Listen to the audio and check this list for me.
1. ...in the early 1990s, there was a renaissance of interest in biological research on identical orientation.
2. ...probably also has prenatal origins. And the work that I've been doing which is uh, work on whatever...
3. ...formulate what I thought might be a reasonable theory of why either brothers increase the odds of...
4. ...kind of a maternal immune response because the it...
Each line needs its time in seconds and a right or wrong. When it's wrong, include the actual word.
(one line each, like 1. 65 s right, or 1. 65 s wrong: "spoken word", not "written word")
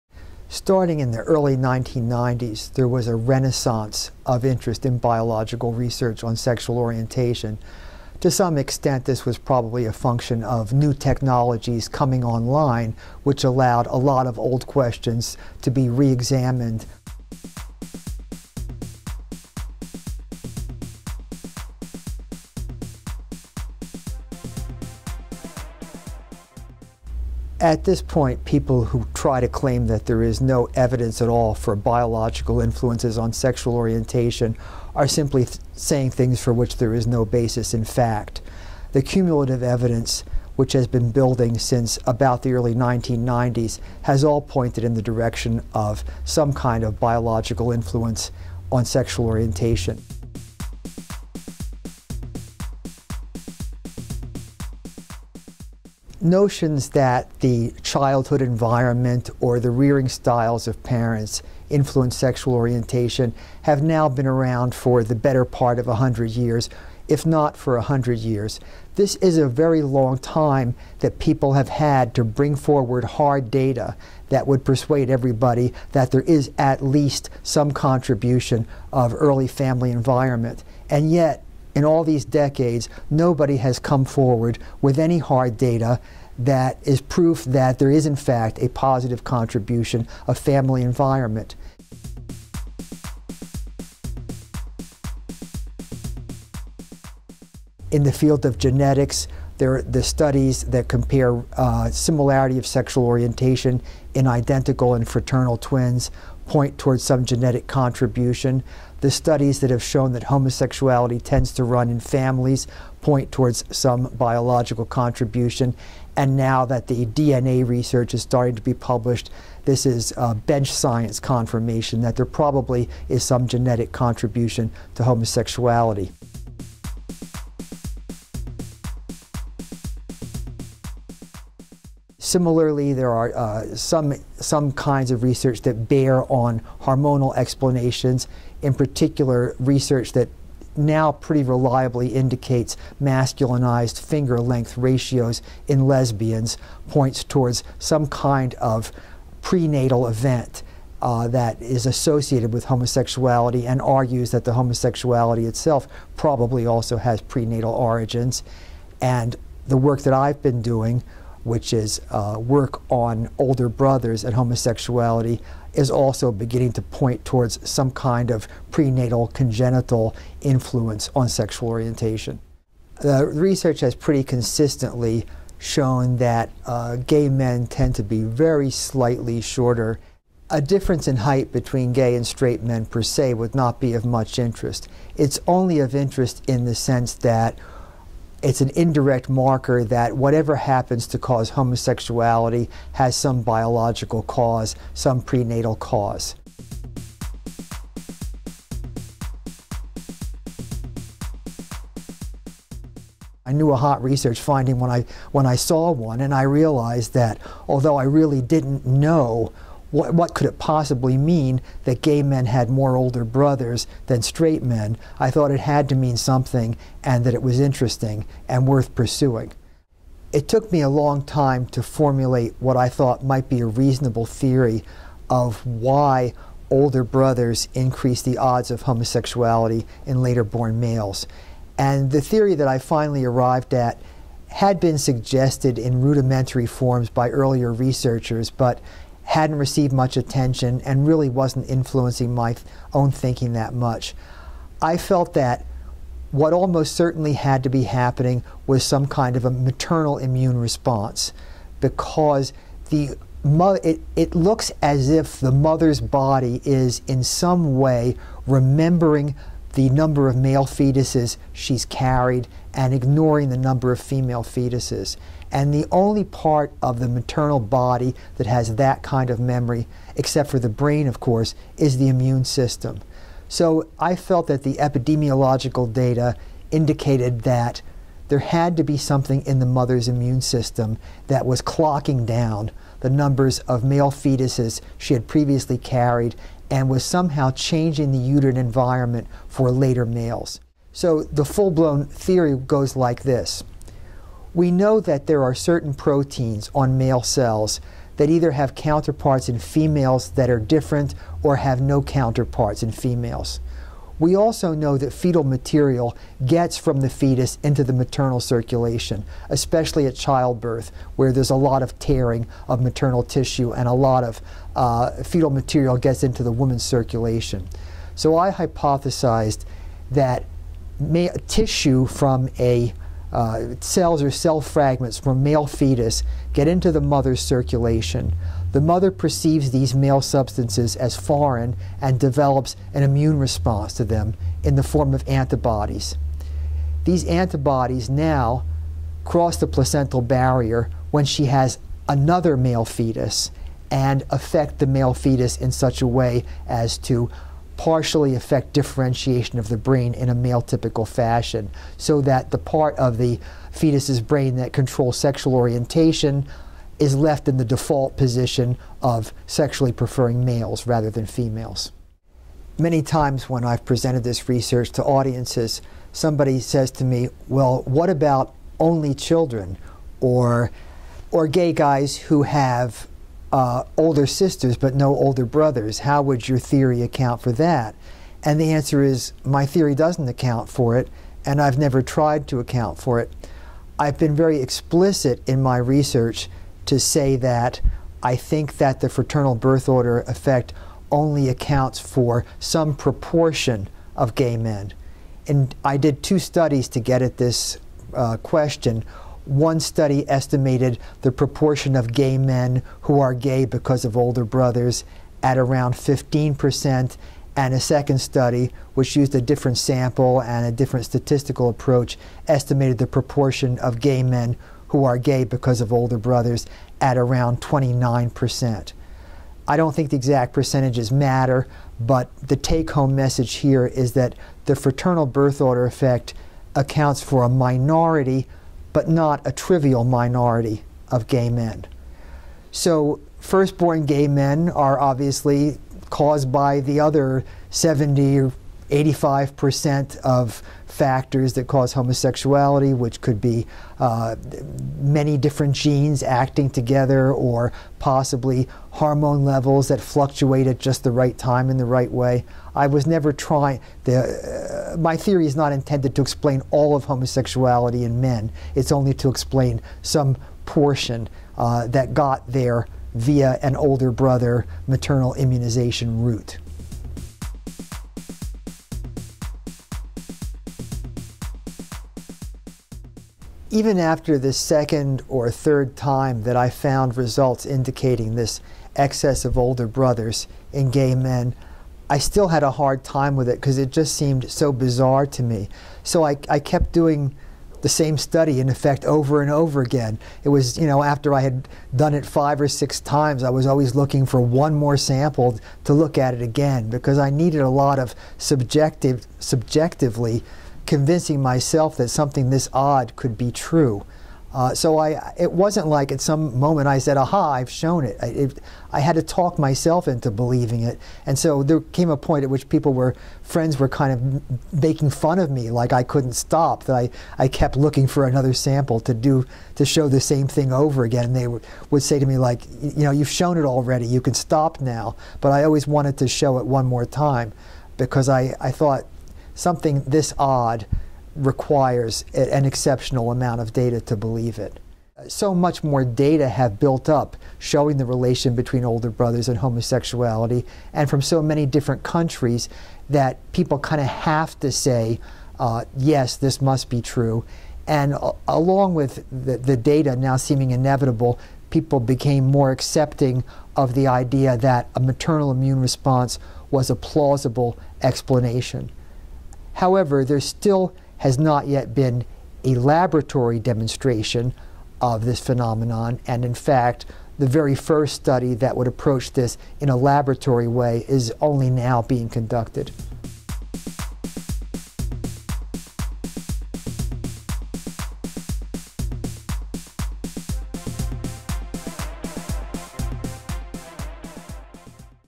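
1. 0 s wrong: "sexual", not "identical"
2. 156 s wrong: "older", not "whatever"
3. 221 s wrong: "older", not "either"
4. 249 s right.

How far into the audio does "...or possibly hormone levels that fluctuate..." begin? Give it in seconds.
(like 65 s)
447 s.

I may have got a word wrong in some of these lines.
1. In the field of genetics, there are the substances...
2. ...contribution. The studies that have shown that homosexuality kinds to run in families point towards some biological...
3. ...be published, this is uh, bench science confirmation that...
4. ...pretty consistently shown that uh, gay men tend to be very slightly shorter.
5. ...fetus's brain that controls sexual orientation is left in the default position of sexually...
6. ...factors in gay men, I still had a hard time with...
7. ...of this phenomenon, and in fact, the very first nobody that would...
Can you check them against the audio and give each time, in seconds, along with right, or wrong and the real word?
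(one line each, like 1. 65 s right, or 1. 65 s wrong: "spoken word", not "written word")
1. 97 s wrong: "studies", not "substances"
2. 107 s wrong: "tends", not "kinds"
3. 118 s right
4. 173 s right
5. 353 s right
6. 479 s wrong: "brothers", not "factors"
7. 564 s wrong: "study", not "nobody".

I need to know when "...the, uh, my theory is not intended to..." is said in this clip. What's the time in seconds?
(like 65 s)
454 s.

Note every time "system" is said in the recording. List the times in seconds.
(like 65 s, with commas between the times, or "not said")
272 s, 280 s.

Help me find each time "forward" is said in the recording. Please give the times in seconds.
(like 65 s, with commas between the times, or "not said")
72 s, 84 s.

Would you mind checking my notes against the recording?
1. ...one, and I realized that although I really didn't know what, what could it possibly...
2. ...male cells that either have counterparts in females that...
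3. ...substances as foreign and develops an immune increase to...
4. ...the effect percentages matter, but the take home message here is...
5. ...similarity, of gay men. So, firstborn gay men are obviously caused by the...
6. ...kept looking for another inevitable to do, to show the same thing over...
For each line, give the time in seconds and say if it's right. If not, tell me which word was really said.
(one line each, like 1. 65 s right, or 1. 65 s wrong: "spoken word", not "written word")
1. 205 s right
2. 296 s right
3. 330 s wrong: "response", not "increase"
4. 420 s wrong: "exact", not "effect"
5. 430 s wrong: "minority", not "similarity"
6. 517 s wrong: "sample", not "inevitable".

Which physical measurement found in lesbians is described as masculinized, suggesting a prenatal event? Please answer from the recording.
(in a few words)
finger length ratios.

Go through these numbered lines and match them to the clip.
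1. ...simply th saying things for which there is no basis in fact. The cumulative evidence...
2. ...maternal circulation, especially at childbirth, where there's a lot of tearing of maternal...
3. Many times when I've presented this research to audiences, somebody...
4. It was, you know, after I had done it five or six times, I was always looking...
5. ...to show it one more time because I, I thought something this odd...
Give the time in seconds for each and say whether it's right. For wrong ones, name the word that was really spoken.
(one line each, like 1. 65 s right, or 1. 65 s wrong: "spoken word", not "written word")
1. 35 s right
2. 307 s right
3. 362 s right
4. 490 s right
5. 526 s right.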